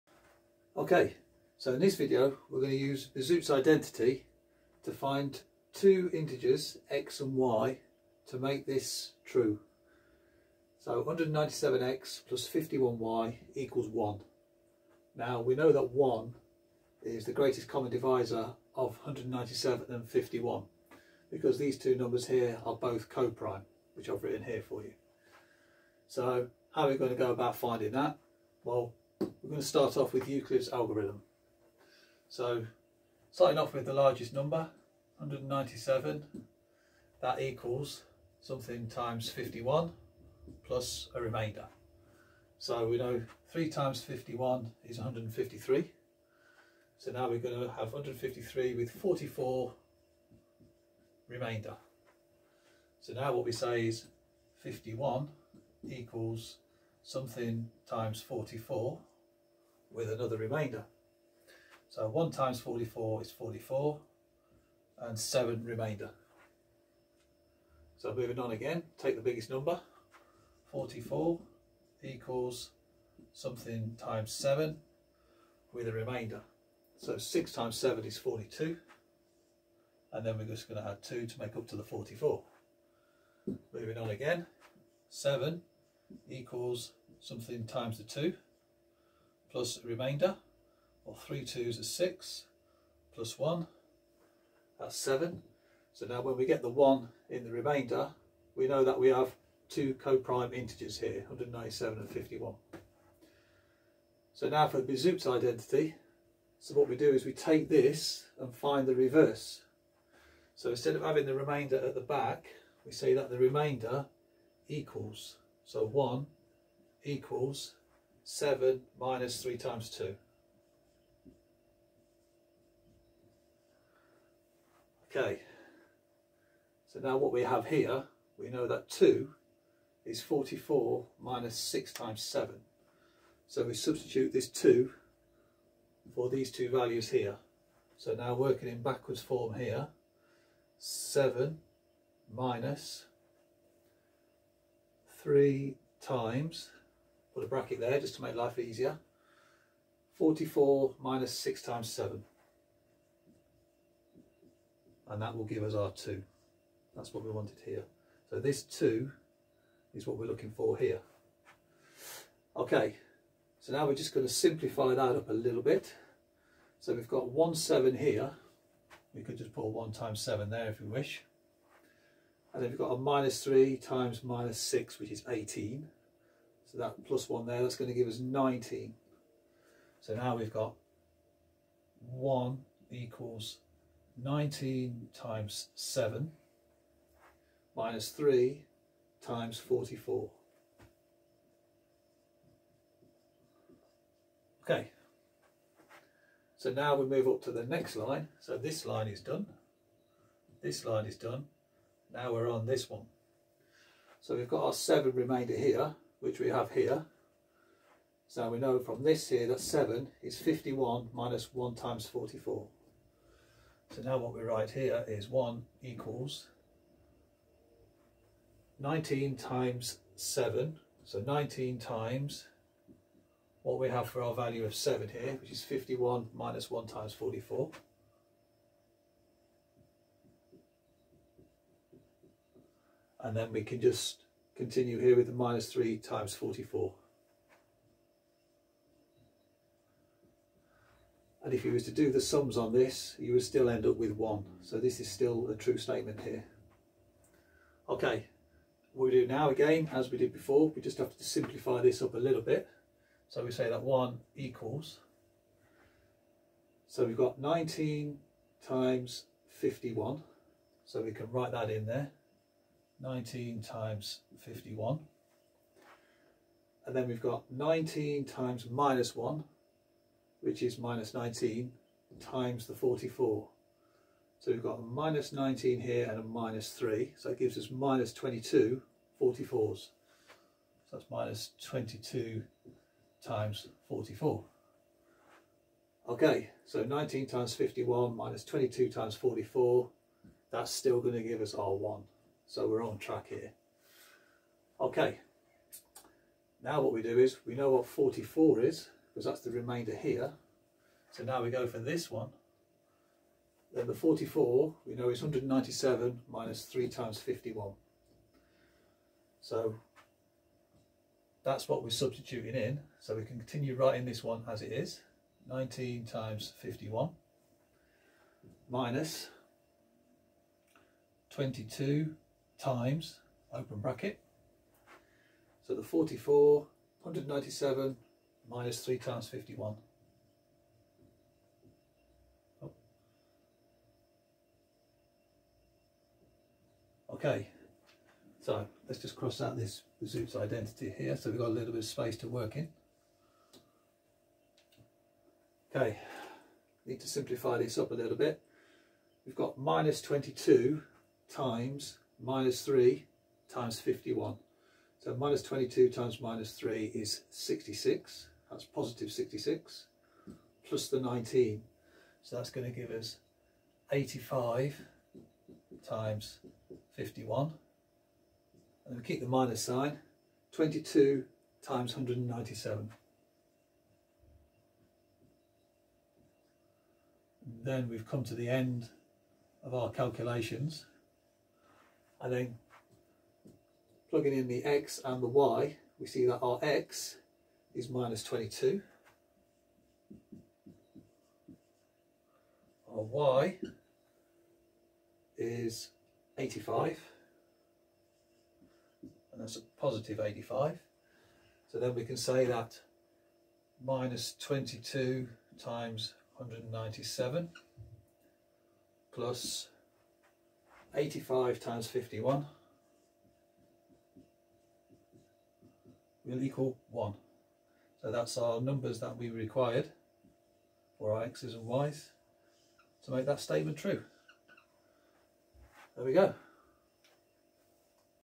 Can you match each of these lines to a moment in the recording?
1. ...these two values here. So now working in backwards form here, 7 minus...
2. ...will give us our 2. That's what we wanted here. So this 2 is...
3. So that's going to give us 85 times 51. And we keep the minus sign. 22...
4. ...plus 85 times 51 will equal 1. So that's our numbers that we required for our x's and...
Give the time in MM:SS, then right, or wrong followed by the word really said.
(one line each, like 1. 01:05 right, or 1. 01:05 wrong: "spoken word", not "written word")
1. 02:16 right
2. 02:35 right
3. 06:02 right
4. 06:49 right.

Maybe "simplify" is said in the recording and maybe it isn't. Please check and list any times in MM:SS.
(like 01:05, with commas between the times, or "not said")
02:44, 04:11, 05:47.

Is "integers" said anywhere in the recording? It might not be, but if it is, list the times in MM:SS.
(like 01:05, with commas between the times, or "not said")
00:06, 01:40.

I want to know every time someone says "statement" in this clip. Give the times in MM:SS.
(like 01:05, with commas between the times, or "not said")
04:05, 07:03.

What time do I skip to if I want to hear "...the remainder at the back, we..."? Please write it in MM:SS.
01:51.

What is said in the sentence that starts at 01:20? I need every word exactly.
And then we're just going to add 2 to make up to the 44.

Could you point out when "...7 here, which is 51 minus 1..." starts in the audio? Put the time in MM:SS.
03:44.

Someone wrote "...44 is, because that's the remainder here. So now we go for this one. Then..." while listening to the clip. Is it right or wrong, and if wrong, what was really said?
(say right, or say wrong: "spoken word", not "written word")
right.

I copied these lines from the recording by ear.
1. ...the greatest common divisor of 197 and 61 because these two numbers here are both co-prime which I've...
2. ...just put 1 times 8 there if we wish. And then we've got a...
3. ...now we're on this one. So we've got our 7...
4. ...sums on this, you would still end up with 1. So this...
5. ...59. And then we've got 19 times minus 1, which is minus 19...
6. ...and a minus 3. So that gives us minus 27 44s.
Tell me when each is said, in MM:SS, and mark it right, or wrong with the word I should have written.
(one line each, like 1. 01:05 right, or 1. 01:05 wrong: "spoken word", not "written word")
1. 00:17 wrong: "51", not "61"
2. 02:49 wrong: "7", not "8"
3. 03:22 right
4. 04:02 right
5. 04:24 wrong: "51", not "59"
6. 04:36 wrong: "22", not "27".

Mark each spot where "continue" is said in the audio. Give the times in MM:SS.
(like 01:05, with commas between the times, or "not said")
03:54, 05:13.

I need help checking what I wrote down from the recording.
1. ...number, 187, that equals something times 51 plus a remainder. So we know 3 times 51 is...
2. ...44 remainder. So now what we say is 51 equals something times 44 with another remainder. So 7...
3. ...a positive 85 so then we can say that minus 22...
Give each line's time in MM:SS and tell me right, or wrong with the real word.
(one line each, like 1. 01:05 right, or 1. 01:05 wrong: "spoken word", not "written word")
1. 00:34 wrong: "197", not "187"
2. 00:48 wrong: "1", not "7"
3. 06:39 right.